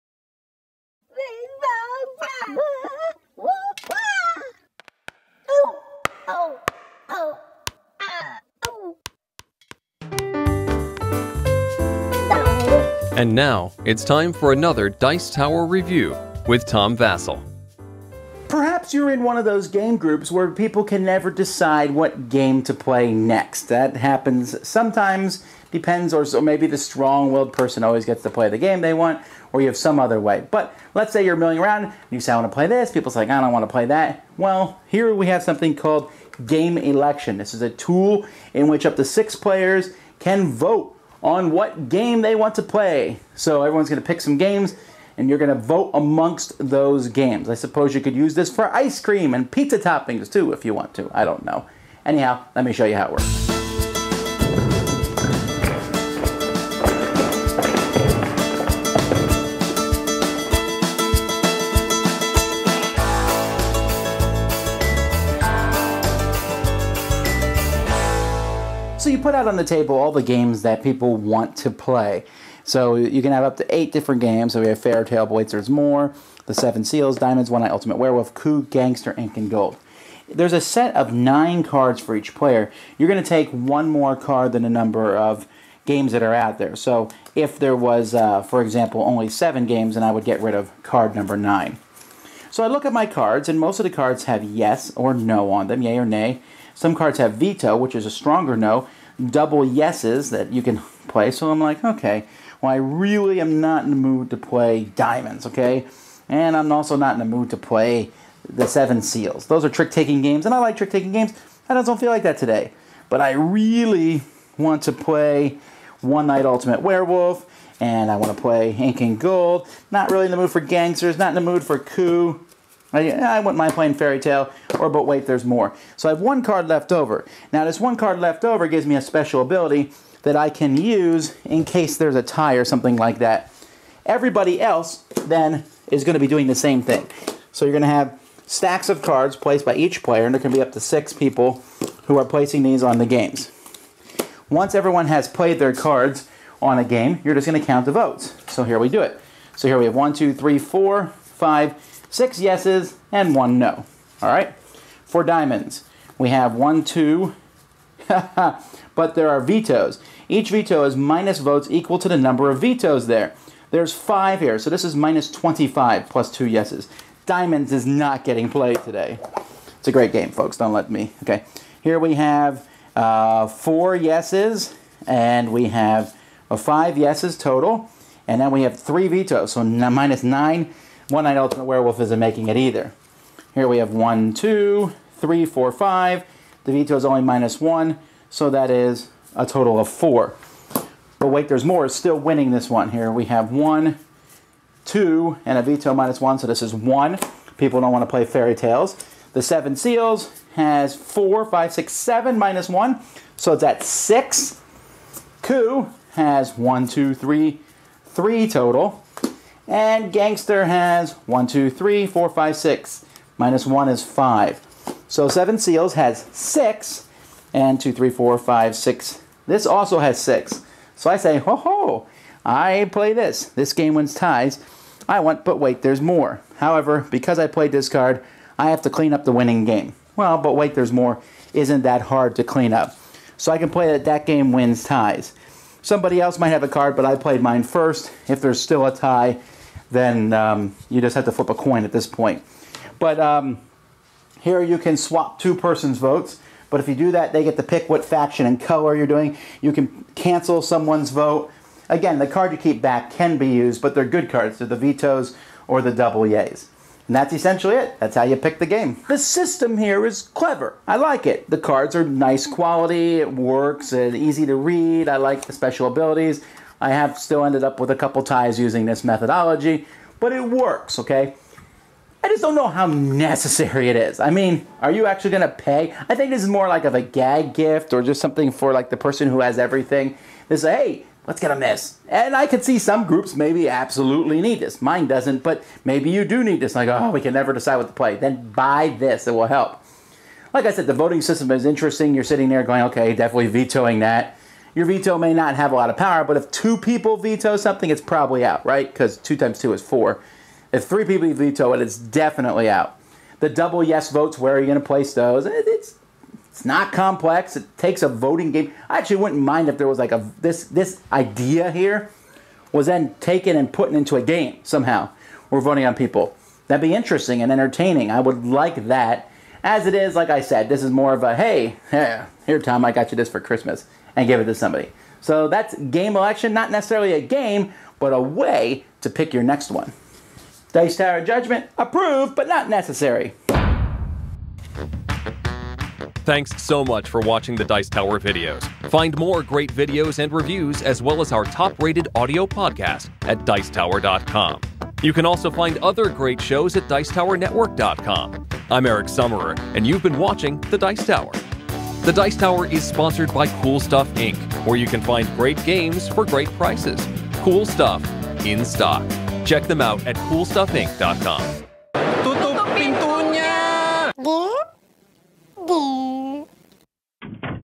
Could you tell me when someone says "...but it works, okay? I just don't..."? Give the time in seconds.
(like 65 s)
270 s.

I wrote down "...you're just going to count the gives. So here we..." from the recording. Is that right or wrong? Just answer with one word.
wrong.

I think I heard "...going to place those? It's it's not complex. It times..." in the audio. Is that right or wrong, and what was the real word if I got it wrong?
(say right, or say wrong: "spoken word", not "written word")
wrong: "takes", not "times".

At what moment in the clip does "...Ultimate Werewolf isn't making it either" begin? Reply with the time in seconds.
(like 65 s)
181 s.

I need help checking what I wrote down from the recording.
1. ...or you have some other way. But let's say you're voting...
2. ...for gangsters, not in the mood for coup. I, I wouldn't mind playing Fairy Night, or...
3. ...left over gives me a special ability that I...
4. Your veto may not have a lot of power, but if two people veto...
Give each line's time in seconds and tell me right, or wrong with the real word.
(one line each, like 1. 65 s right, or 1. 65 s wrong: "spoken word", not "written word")
1. 29 s wrong: "milling", not "voting"
2. 120 s wrong: "Tale", not "Night"
3. 128 s right
4. 294 s right.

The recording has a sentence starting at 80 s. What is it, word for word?
There's a set of nine cards for each player.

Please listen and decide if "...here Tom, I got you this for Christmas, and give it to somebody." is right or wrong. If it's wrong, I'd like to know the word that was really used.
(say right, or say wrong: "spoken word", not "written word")
right.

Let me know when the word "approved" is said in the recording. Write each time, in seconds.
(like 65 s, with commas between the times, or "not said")
331 s.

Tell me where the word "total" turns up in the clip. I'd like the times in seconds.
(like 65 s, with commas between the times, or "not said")
177 s, 189 s, 208 s.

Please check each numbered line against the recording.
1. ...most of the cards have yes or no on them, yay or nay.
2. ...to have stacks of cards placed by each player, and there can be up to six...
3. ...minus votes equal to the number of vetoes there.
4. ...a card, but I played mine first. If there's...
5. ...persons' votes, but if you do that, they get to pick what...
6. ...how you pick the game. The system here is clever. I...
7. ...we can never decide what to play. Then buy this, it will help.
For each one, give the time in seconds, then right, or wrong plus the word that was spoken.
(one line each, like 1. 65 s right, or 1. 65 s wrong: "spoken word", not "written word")
1. 93 s right
2. 137 s right
3. 160 s right
4. 236 s right
5. 245 s right
6. 258 s right
7. 287 s right.